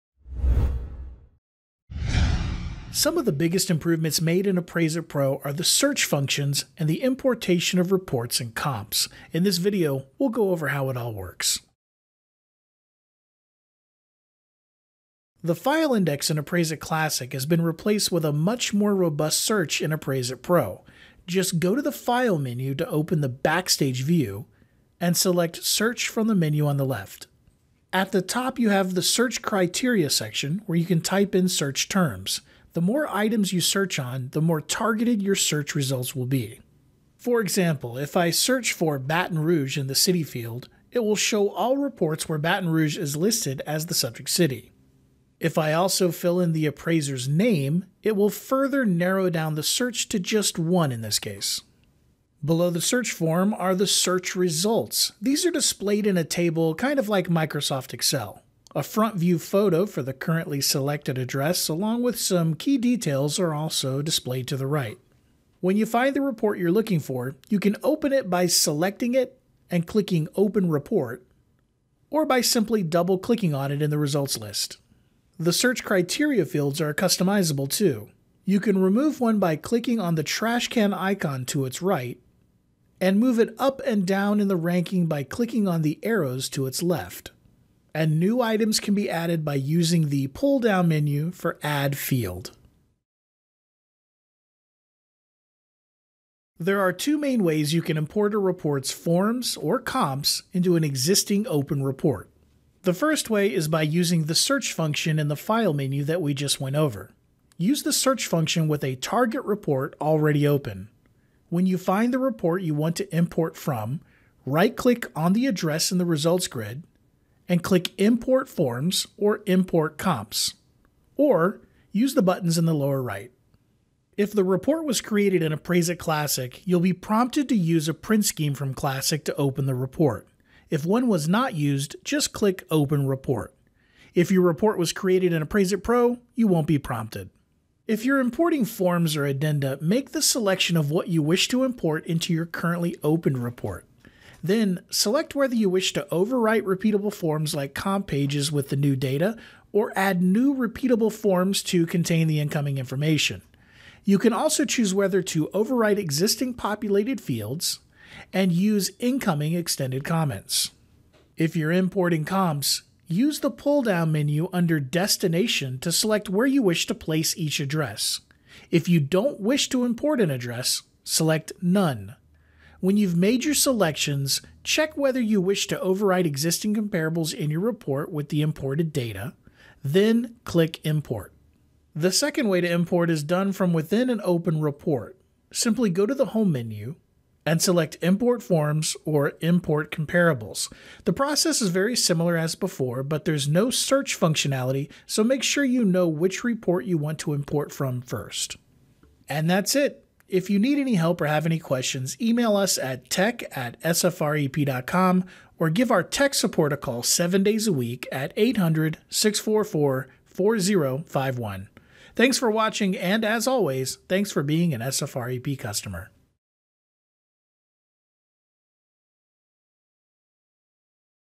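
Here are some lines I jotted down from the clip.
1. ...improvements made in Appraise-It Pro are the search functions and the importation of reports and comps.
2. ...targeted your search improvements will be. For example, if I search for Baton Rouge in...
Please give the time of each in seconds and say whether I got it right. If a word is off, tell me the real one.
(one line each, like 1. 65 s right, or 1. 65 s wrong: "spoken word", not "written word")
1. 3 s right
2. 34 s wrong: "results", not "improvements".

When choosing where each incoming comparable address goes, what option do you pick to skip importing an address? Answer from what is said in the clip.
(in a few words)
None.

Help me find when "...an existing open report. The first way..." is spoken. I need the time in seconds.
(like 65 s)
100 s.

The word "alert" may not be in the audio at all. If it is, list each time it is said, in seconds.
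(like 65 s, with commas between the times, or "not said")
not said.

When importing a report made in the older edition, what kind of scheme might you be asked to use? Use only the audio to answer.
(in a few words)
Print scheme.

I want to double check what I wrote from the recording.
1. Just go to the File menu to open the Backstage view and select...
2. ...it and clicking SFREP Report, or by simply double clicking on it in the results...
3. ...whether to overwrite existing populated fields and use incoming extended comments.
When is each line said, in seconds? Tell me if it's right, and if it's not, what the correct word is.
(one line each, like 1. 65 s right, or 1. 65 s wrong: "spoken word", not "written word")
1. 21 s right
2. 69 s wrong: "Open", not "SFREP"
3. 154 s right.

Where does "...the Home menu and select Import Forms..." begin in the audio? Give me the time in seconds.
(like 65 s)
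186 s.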